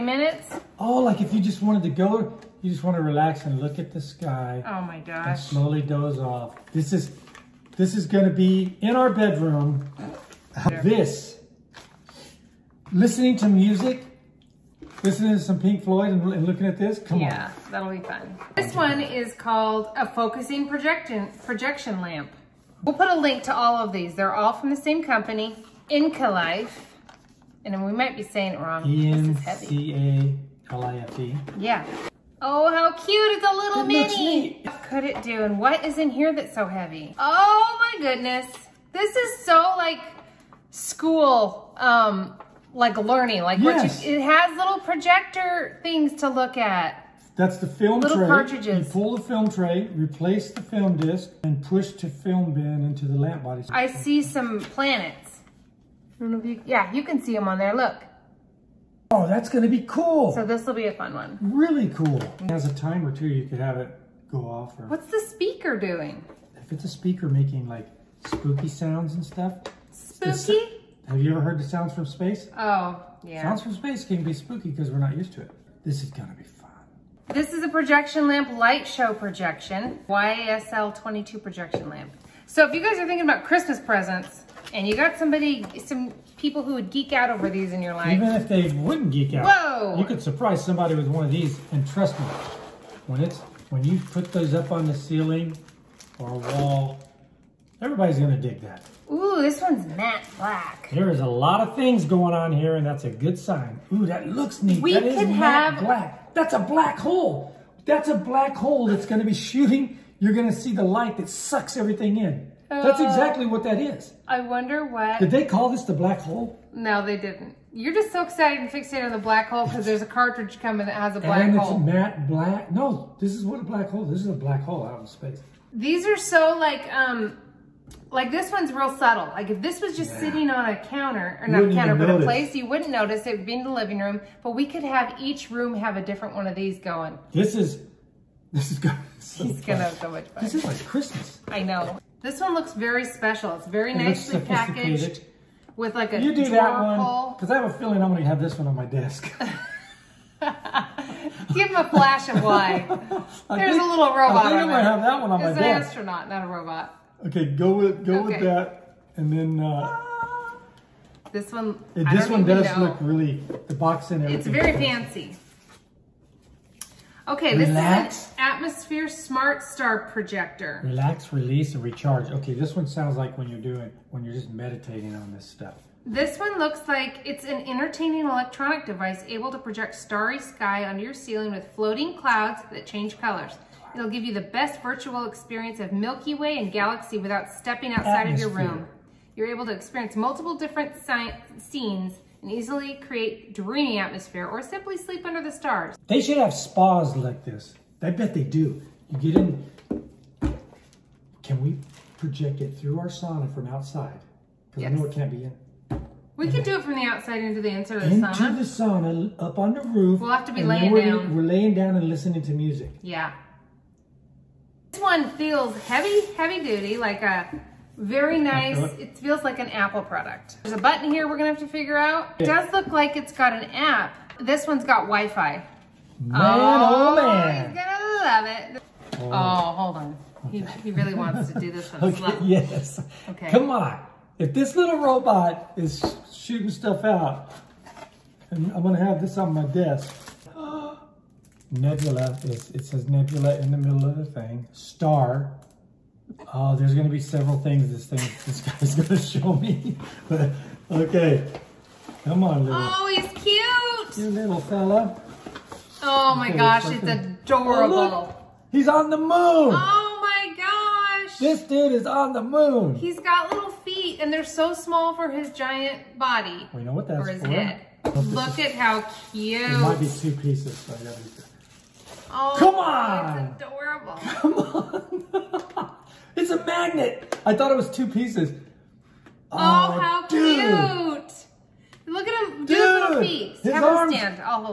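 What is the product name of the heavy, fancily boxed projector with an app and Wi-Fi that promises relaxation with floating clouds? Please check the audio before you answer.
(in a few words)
Atmosphere Smart Star projector.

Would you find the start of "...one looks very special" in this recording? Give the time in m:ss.
2:22.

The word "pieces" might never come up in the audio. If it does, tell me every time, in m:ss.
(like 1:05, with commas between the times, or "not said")
4:30, 4:38.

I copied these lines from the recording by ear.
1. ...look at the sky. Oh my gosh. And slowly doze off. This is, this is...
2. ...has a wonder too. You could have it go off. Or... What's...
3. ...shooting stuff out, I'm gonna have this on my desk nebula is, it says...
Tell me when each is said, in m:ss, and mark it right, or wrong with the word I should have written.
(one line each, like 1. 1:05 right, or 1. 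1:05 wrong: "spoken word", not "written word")
1. 0:03 right
2. 1:02 wrong: "timer", not "wonder"
3. 3:56 right.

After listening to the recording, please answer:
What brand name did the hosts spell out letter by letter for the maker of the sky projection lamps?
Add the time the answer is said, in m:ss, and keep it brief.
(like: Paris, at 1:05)
ENCALIFE, at 0:28.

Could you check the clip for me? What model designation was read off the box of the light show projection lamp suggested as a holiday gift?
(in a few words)
YSL 22.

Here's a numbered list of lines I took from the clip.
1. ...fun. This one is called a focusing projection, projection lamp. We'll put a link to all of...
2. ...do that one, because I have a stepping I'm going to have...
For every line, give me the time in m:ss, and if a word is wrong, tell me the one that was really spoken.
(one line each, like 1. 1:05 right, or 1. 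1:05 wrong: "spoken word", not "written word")
1. 0:17 right
2. 2:26 wrong: "feeling", not "stepping".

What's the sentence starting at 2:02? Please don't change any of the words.
No, this is what a black hole.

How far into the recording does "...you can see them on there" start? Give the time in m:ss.
0:56.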